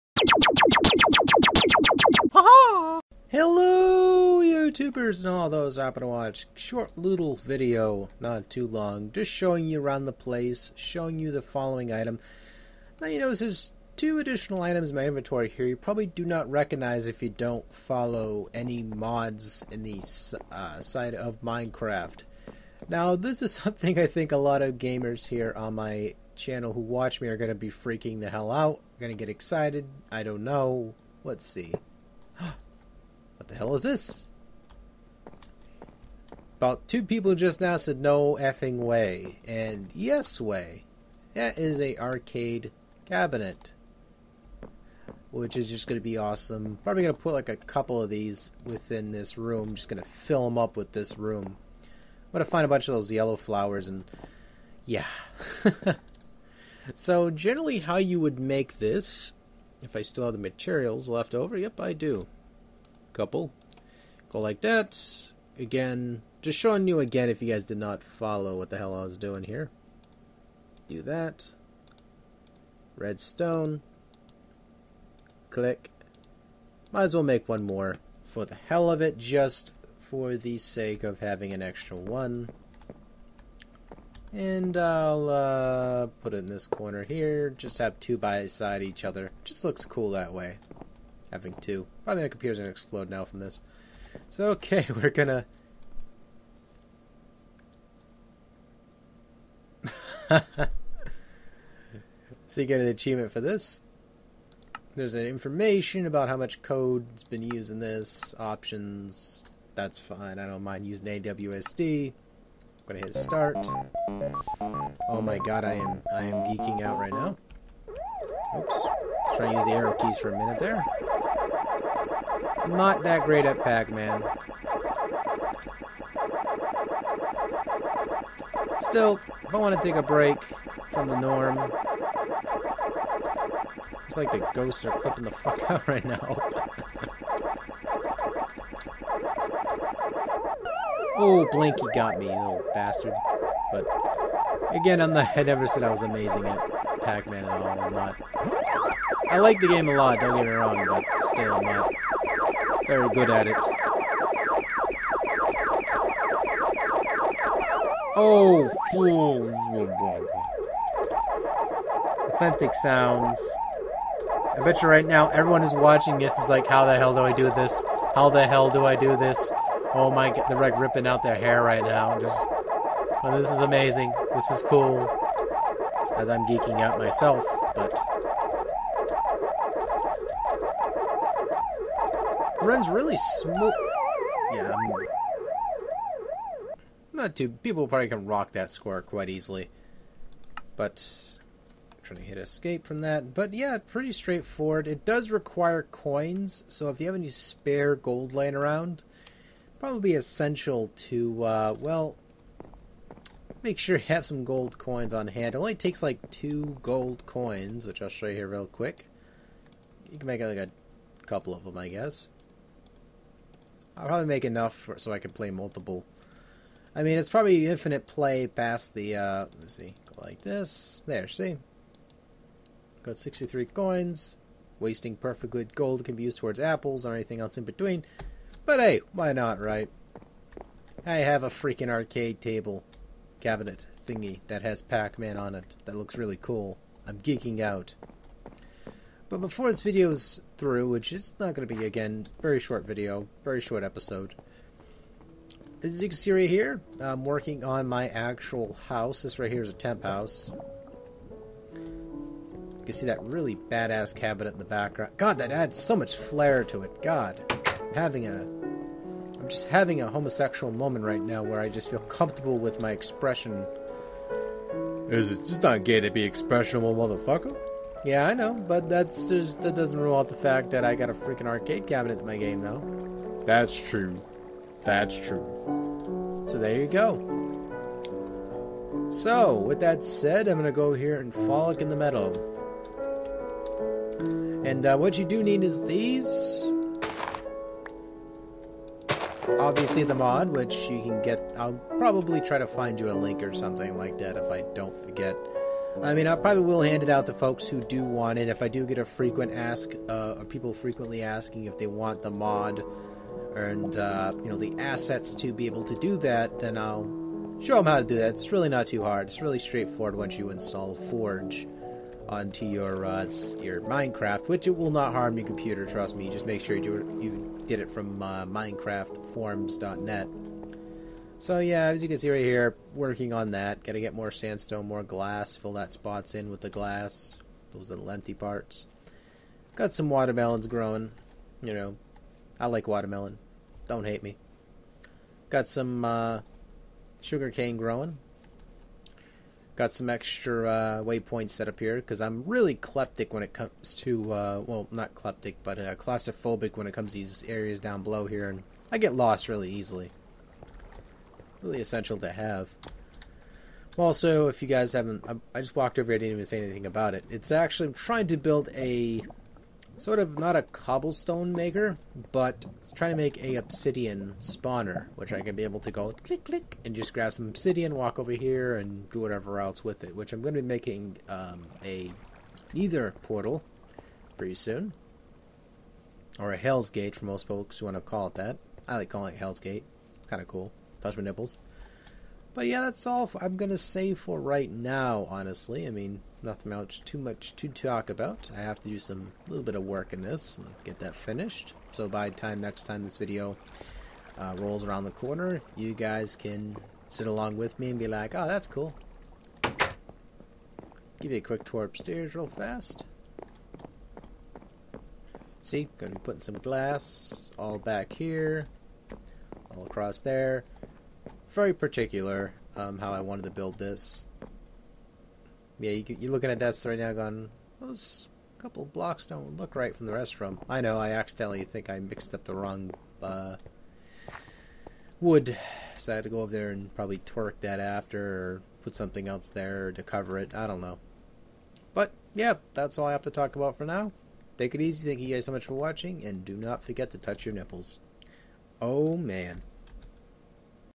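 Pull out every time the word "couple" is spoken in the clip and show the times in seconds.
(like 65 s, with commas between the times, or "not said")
47 s, 63 s, 211 s, 418 s.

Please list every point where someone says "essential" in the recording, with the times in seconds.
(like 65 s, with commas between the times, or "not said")
200 s, 351 s.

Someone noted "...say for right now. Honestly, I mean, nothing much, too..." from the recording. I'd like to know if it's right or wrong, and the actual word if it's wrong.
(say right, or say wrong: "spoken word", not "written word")
right.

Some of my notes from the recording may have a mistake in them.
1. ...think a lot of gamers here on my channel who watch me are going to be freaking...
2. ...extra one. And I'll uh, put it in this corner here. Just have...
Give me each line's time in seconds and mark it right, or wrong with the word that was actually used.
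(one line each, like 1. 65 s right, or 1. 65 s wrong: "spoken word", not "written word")
1. 24 s right
2. 81 s right.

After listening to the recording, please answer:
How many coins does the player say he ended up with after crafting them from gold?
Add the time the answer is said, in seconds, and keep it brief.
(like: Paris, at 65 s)
63, at 223 s.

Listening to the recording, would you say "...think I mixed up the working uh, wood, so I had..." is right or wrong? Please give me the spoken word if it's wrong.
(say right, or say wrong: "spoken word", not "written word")
wrong: "wrong", not "working".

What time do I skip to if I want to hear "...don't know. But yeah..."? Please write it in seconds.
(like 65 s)
430 s.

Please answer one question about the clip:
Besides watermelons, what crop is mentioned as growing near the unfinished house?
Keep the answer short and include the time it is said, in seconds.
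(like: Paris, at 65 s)
sugar cane, at 337 s.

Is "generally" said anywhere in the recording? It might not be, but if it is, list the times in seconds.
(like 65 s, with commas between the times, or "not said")
57 s.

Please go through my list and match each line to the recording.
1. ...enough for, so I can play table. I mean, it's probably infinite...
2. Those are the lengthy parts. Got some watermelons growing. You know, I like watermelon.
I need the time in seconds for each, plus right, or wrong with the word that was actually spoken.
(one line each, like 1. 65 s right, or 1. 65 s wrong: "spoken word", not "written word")
1. 214 s wrong: "multiple", not "table"
2. 327 s right.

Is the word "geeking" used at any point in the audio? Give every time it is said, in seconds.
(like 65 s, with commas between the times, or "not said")
116 s, 176 s, 237 s.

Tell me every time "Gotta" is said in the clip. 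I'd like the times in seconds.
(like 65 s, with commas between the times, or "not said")
323 s.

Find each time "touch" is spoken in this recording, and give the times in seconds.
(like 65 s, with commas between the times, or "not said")
381 s, 437 s.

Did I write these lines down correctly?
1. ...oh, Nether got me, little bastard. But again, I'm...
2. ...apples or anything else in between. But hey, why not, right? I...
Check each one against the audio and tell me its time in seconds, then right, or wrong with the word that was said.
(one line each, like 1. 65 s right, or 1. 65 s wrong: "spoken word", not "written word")
1. 141 s wrong: "Blinky", not "Nether"
2. 226 s right.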